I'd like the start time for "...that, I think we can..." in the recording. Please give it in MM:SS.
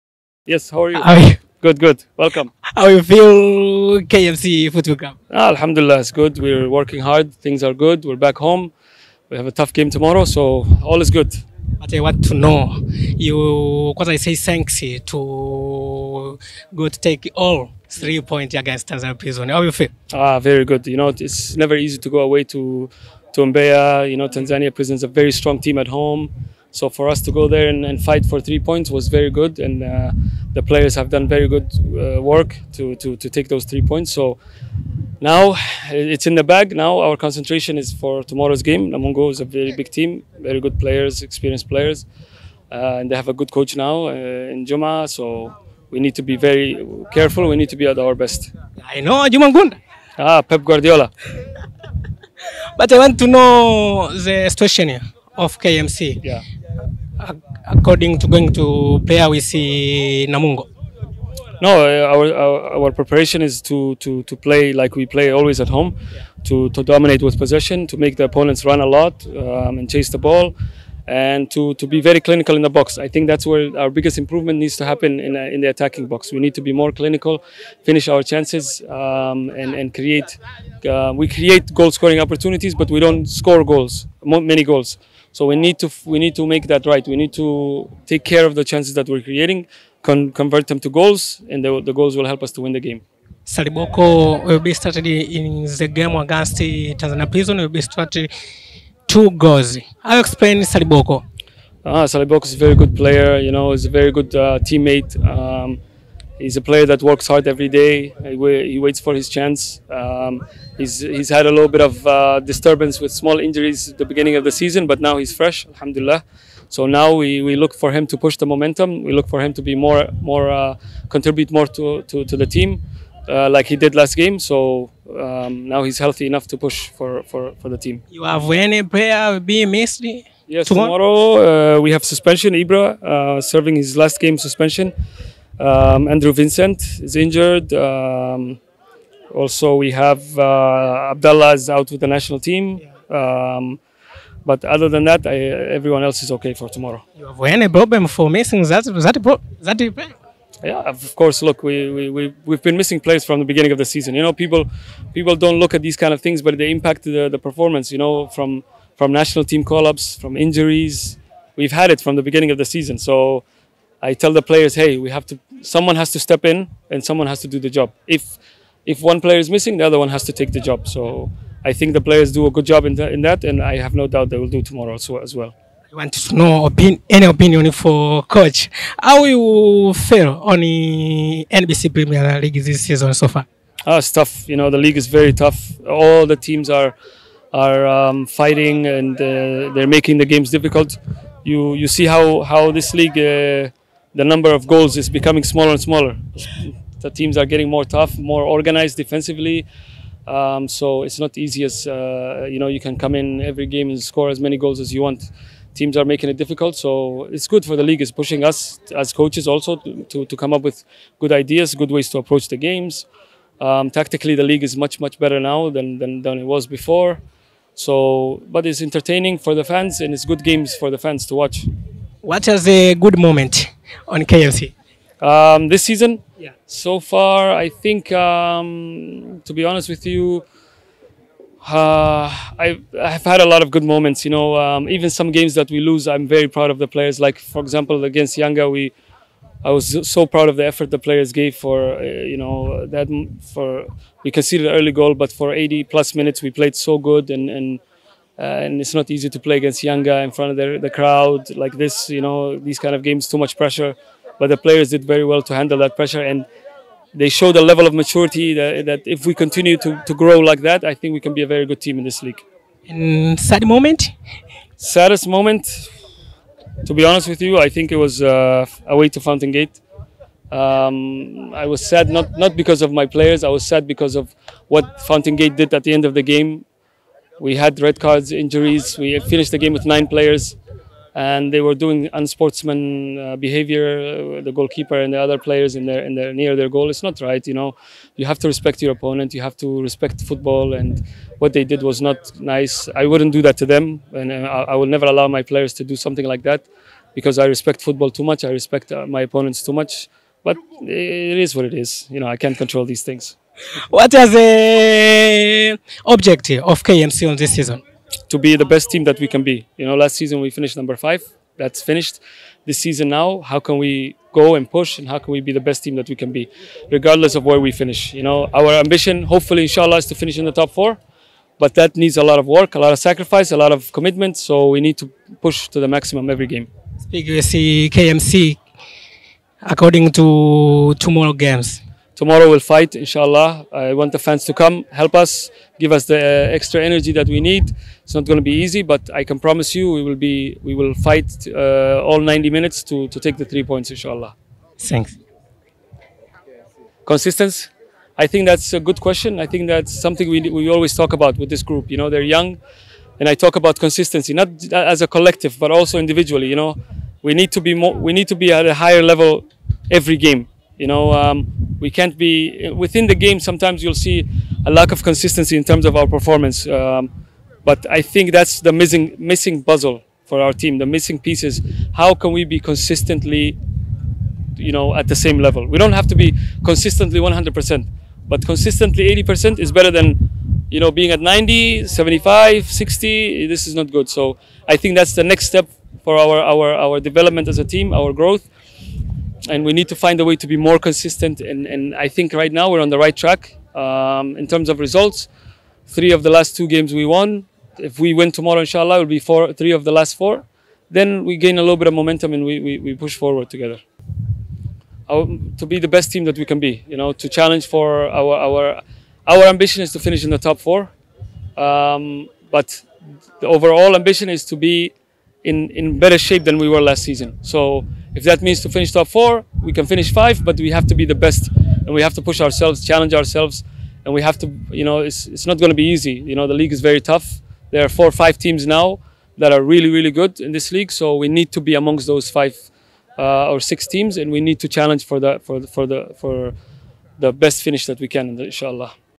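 04:20.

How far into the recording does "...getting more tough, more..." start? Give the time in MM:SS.
03:17.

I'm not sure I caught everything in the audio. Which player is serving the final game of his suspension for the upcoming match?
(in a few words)
Ibra.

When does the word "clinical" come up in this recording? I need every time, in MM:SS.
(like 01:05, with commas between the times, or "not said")
01:12, 01:16.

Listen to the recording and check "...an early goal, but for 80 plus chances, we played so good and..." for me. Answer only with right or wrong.
wrong.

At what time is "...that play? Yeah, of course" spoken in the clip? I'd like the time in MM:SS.
02:29.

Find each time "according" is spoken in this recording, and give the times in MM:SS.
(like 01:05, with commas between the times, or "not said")
00:57, 05:29.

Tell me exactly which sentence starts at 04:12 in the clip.
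You know, these kind of games, too much pressure.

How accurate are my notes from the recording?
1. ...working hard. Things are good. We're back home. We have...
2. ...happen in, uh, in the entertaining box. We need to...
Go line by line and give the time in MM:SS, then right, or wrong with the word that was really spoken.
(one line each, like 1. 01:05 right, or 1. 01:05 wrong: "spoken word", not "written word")
1. 00:06 right
2. 01:14 wrong: "attacking", not "entertaining".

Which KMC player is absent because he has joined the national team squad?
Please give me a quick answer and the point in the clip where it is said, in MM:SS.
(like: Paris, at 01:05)
Abdallah, at 02:21.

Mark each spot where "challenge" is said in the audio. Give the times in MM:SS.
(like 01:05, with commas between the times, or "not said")
06:47, 07:02, 07:14.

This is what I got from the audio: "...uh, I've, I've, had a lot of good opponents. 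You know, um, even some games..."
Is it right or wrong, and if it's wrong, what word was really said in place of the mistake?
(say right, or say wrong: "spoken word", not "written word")
wrong: "moments", not "opponents".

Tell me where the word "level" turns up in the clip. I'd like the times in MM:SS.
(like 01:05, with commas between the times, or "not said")
04:17, 05:59, 06:15.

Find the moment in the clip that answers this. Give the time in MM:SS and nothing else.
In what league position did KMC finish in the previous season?
05:10.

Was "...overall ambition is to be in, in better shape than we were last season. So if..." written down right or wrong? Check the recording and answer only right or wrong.
right.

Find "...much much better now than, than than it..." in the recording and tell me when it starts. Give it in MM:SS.
03:34.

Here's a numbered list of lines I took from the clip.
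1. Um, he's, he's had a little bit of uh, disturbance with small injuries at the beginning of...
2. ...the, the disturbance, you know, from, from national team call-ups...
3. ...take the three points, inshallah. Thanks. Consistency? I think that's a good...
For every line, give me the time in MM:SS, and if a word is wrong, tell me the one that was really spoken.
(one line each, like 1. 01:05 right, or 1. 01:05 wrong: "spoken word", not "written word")
1. 01:49 right
2. 02:37 wrong: "performance", not "disturbance"
3. 05:43 right.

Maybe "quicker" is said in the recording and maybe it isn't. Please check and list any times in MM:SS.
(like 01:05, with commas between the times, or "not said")
not said.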